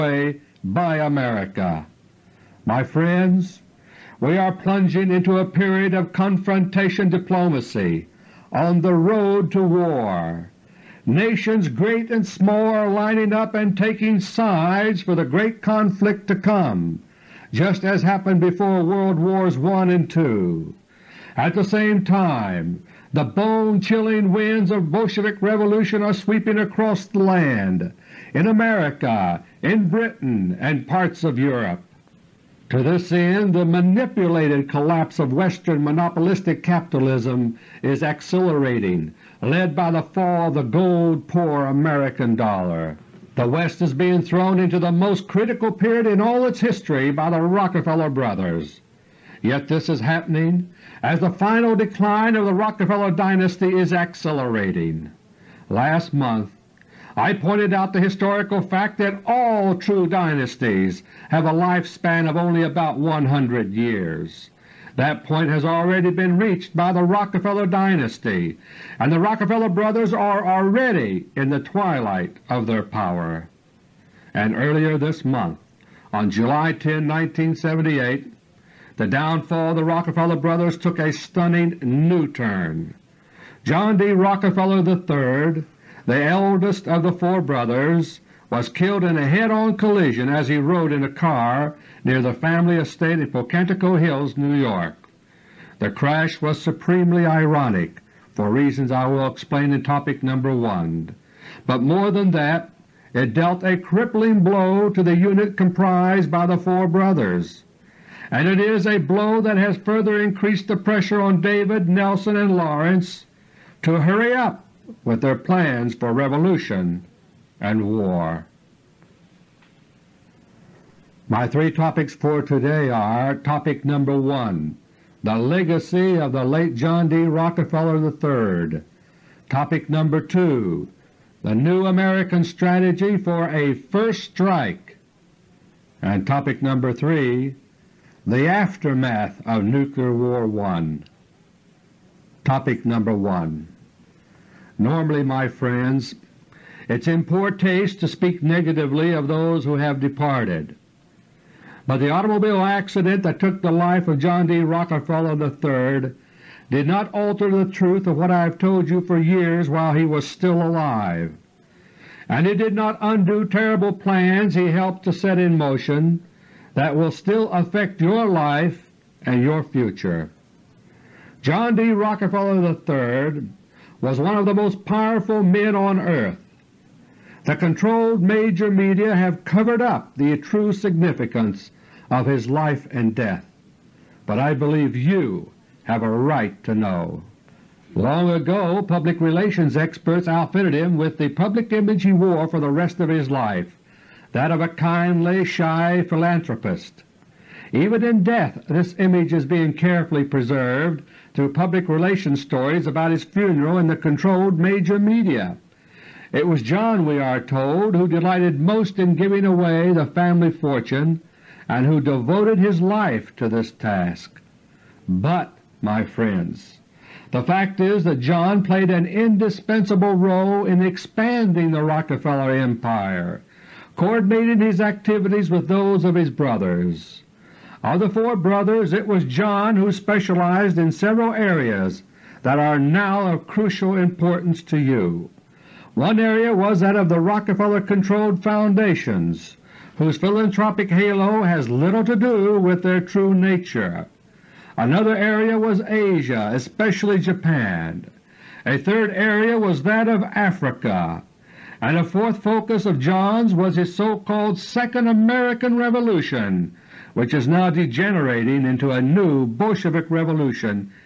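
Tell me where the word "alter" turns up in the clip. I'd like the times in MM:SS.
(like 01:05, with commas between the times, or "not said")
02:37.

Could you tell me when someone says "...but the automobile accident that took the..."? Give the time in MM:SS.
02:31.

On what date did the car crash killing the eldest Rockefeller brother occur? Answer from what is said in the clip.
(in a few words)
July 10, 1978.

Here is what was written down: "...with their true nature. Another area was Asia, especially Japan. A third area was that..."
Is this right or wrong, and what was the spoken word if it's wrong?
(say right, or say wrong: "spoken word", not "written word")
right.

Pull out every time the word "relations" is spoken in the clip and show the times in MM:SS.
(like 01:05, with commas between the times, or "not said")
03:09, 03:21.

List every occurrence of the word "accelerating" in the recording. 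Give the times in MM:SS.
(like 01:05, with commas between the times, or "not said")
00:38, 00:53.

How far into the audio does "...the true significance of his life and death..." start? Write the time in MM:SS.
03:00.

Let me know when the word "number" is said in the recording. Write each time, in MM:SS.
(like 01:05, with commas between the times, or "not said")
02:03, 02:09, 02:16, 02:22.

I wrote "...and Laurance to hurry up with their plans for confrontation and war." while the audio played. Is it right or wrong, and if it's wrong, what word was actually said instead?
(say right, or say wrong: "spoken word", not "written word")
wrong: "revolution", not "confrontation".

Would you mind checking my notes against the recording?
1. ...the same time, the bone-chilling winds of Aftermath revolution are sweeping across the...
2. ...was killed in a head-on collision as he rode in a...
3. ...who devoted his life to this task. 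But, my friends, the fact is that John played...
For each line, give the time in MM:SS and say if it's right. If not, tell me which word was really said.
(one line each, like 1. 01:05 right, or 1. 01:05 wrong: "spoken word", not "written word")
1. 00:21 wrong: "Bolshevik", not "Aftermath"
2. 01:28 right
3. 03:31 right.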